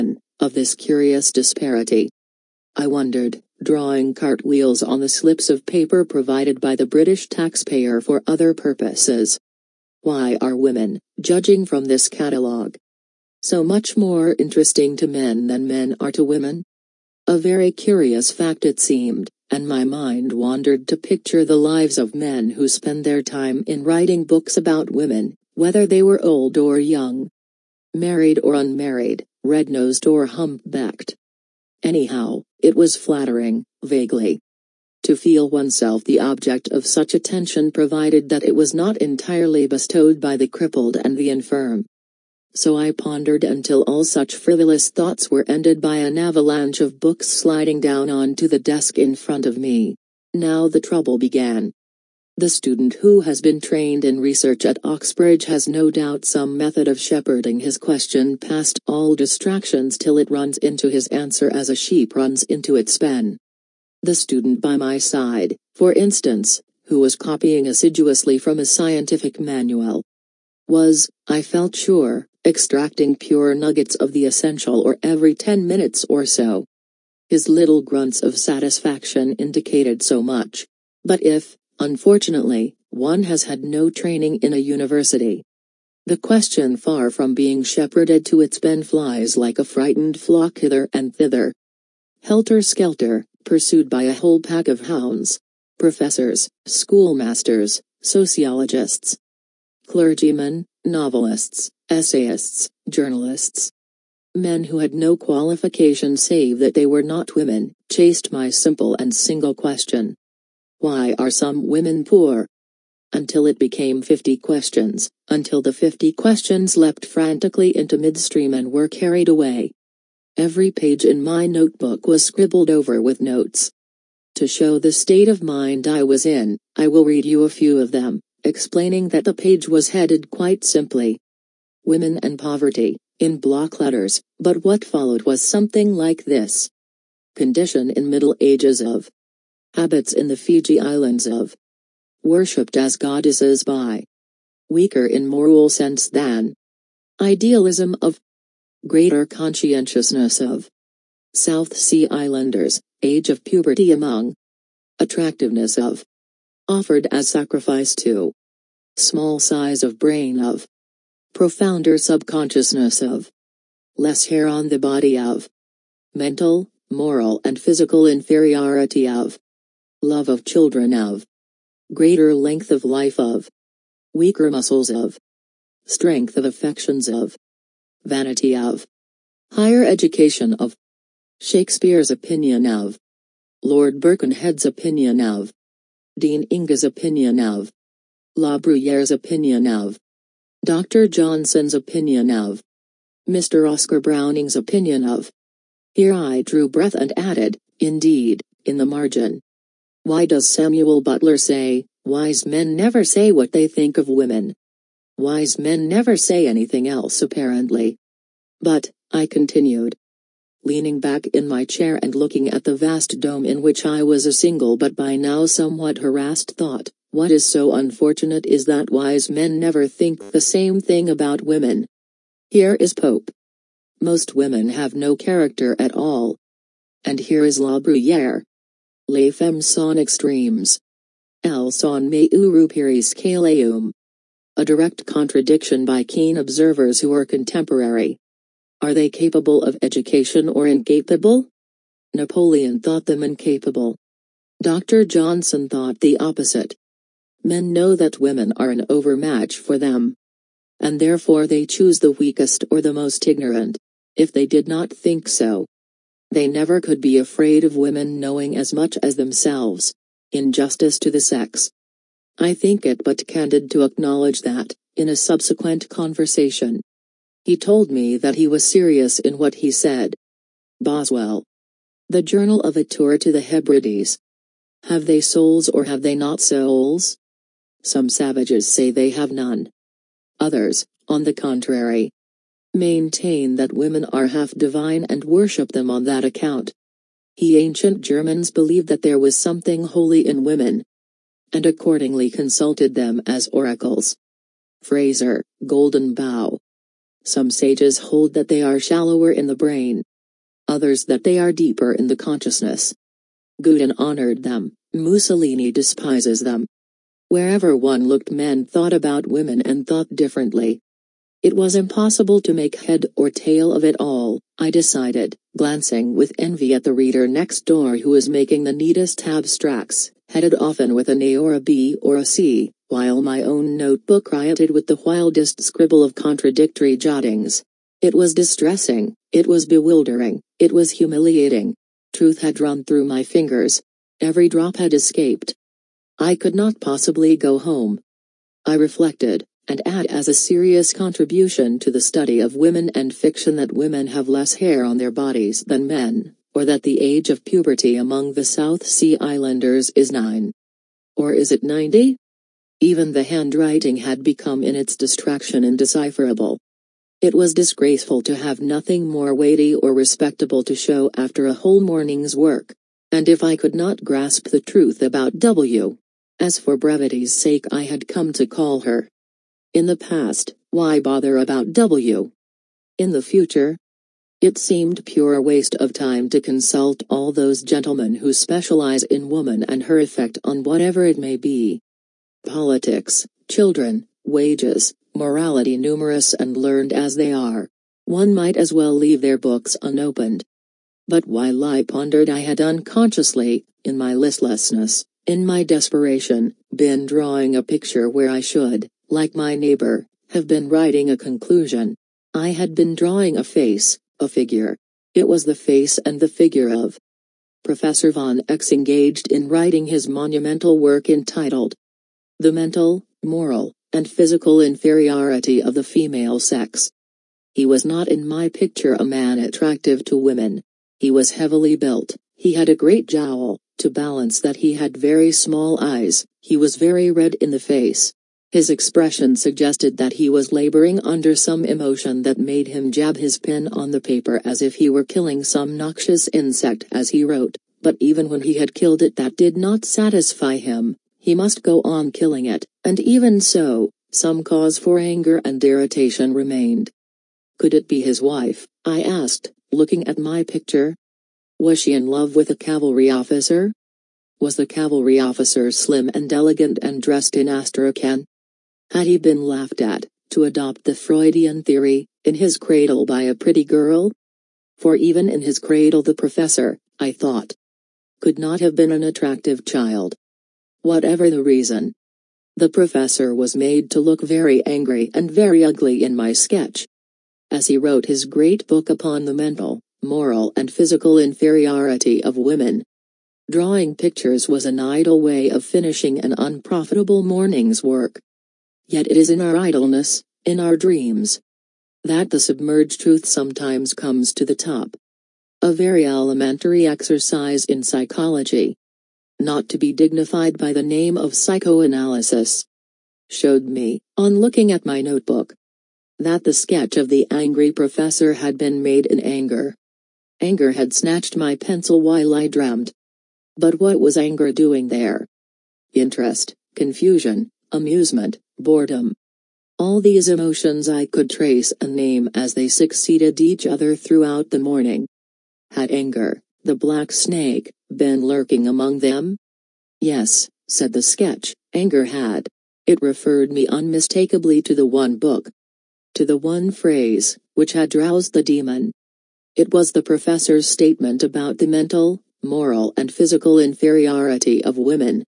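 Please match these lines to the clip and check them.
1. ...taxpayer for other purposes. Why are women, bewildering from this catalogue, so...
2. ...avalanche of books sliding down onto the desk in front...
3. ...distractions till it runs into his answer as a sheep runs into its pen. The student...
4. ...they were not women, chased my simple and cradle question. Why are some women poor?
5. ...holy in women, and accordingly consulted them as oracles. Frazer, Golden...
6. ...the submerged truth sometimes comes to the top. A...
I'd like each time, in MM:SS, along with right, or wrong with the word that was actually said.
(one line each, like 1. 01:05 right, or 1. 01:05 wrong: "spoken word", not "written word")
1. 00:07 wrong: "judging", not "bewildering"
2. 00:46 right
3. 00:59 right
4. 01:46 wrong: "single", not "cradle"
5. 04:49 right
6. 08:12 right.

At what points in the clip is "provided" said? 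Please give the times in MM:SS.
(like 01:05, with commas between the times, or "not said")
00:06, 00:37.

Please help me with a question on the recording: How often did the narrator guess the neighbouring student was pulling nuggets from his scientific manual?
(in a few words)
every 10 minutes.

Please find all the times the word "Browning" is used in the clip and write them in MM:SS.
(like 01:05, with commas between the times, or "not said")
03:14.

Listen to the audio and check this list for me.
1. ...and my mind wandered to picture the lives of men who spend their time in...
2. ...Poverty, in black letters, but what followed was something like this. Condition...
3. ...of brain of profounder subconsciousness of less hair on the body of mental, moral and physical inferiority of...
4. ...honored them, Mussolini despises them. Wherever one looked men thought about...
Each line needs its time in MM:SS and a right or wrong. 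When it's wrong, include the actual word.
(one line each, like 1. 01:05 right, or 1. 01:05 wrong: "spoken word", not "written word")
1. 00:19 right
2. 02:12 wrong: "block", not "black"
3. 02:39 right
4. 05:03 right.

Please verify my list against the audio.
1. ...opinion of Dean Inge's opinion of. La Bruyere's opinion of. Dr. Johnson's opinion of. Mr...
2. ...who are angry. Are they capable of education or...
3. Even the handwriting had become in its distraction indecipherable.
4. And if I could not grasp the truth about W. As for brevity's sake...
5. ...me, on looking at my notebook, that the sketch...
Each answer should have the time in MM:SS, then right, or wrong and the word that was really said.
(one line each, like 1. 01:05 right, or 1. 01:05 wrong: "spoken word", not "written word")
1. 03:04 right
2. 03:57 wrong: "contemporary", not "angry"
3. 05:52 right
4. 06:03 right
5. 08:23 right.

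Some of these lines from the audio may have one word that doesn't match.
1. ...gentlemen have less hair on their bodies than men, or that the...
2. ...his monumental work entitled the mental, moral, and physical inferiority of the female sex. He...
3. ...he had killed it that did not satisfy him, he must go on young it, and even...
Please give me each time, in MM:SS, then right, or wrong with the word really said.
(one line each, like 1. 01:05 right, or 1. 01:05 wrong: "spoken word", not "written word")
1. 05:43 wrong: "women", not "gentlemen"
2. 06:49 right
3. 07:18 wrong: "killing", not "young".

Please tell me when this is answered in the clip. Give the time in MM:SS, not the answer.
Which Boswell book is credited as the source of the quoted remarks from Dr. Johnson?
04:32.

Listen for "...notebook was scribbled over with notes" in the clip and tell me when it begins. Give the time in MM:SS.
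02:01.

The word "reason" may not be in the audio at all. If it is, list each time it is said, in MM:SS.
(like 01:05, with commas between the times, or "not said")
07:51.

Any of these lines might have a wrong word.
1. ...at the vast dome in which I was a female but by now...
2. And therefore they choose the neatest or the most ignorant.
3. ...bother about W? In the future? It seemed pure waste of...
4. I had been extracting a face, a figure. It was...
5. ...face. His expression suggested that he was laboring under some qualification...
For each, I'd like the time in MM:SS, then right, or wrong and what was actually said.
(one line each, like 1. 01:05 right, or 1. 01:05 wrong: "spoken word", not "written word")
1. 03:32 wrong: "single", not "female"
2. 04:10 wrong: "weakest", not "neatest"
3. 06:11 right
4. 06:42 wrong: "drawing", not "extracting"
5. 07:07 wrong: "emotion", not "qualification".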